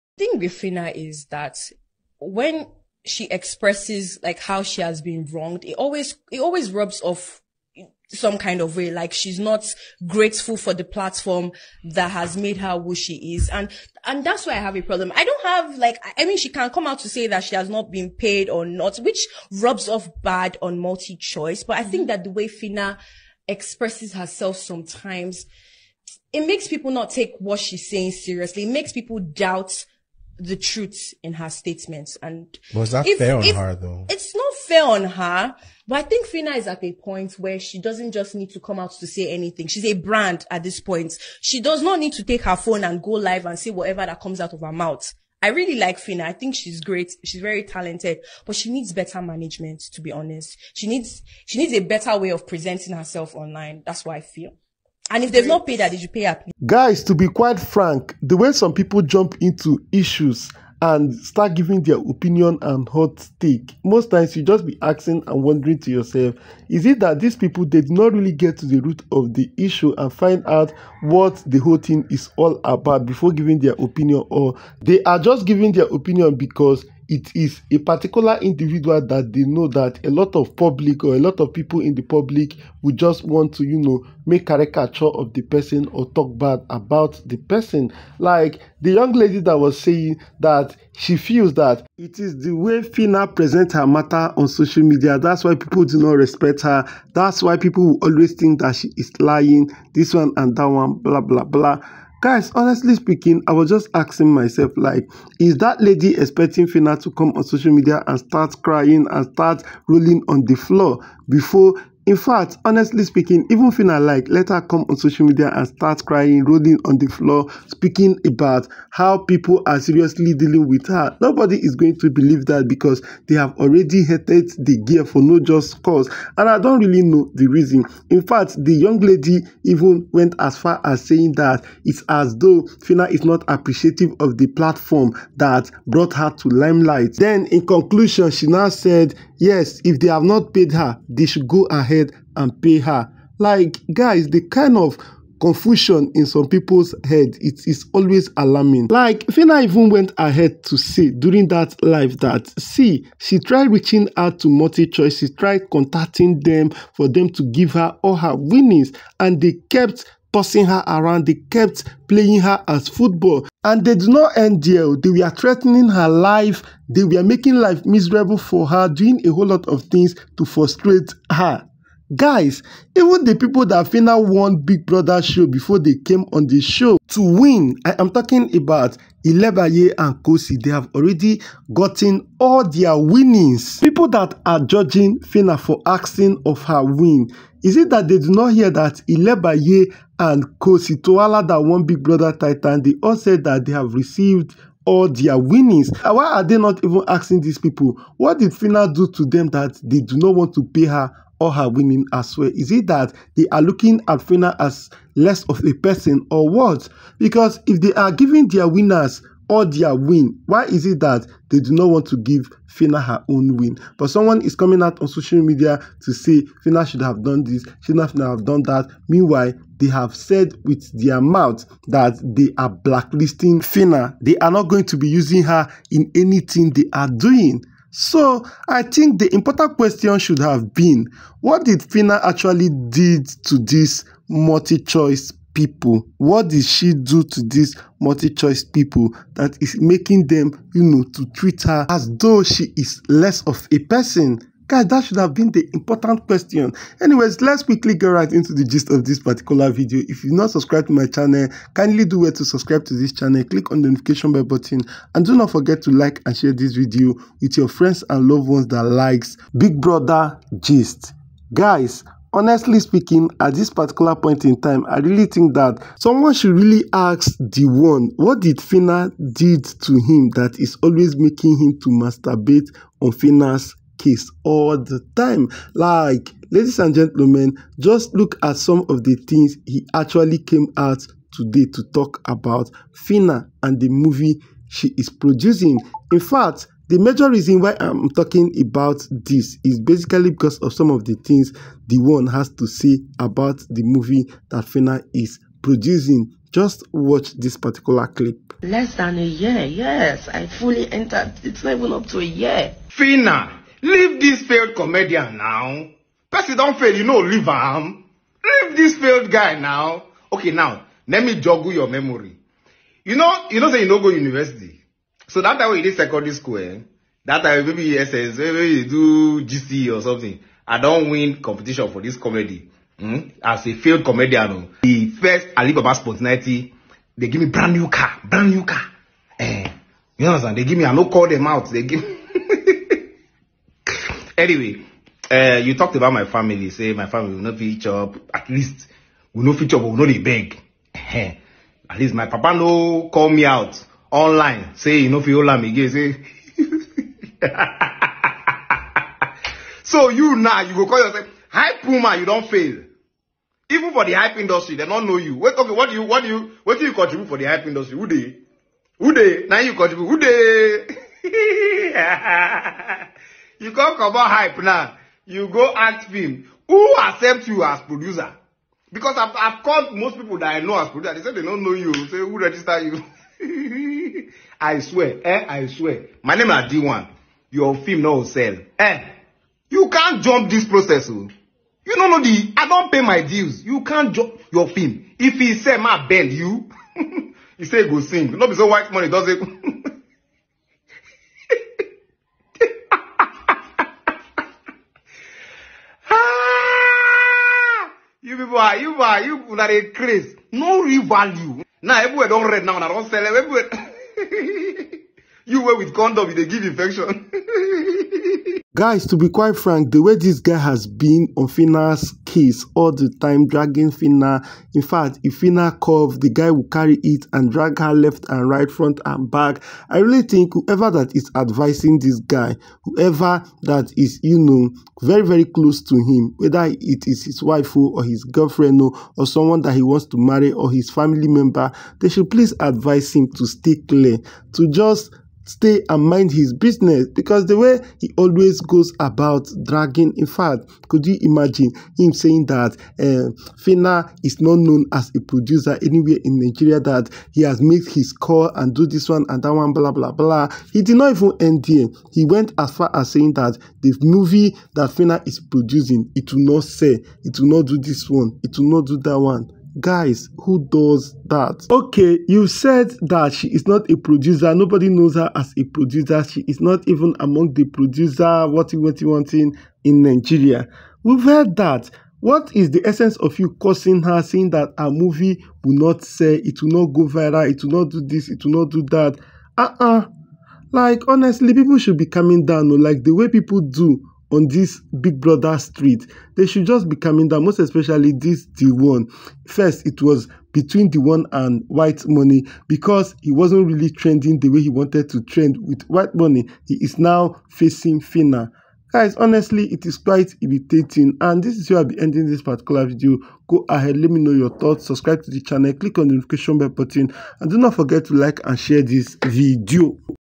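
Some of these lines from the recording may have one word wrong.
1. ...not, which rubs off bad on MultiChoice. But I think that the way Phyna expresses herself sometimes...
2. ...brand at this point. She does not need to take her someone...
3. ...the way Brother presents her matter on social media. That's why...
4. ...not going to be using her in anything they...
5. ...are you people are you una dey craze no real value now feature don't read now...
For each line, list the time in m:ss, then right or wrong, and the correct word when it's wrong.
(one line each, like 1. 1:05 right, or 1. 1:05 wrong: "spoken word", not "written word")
1. 0:18 right
2. 0:39 wrong: "phone", not "someone"
3. 1:32 wrong: "Fina", not "Brother"
4. 3:44 right
5. 6:38 wrong: "everywhere", not "feature".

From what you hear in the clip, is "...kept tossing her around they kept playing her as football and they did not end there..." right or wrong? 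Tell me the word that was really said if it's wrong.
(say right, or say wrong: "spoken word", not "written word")
right.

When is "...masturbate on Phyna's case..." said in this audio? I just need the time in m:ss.
4:31.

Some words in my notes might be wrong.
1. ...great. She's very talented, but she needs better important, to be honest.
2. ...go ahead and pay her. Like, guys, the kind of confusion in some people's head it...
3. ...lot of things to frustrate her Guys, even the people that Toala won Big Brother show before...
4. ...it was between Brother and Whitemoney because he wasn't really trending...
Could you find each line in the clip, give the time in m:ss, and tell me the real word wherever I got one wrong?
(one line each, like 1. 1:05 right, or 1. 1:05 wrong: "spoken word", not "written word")
1. 0:46 wrong: "management", not "important"
2. 2:21 right
3. 2:49 wrong: "Fina", not "Toala"
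4. 8:09 wrong: "Deeone", not "Brother".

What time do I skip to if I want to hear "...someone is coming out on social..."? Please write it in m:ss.
3:34.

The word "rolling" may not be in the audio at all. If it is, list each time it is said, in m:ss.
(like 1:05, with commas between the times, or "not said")
1:49, 1:56.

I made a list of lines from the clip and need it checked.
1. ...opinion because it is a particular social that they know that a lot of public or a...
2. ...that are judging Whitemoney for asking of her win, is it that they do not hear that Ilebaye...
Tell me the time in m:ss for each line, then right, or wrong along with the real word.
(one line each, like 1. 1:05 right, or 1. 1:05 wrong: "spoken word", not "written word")
1. 1:15 wrong: "individual", not "social"
2. 3:04 wrong: "Fina", not "Whitemoney".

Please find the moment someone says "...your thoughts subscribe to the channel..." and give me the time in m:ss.
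8:24.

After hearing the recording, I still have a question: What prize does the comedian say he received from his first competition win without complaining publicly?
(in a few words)
Brand new car.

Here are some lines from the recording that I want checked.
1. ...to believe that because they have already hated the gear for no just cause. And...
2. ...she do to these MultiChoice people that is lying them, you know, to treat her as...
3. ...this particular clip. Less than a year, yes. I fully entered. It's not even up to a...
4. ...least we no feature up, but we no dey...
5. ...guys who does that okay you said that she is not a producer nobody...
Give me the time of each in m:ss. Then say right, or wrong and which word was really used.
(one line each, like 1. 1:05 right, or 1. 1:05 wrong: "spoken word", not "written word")
1. 2:01 right
2. 3:56 wrong: "making", not "lying"
3. 4:57 right
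4. 5:38 right
5. 7:39 right.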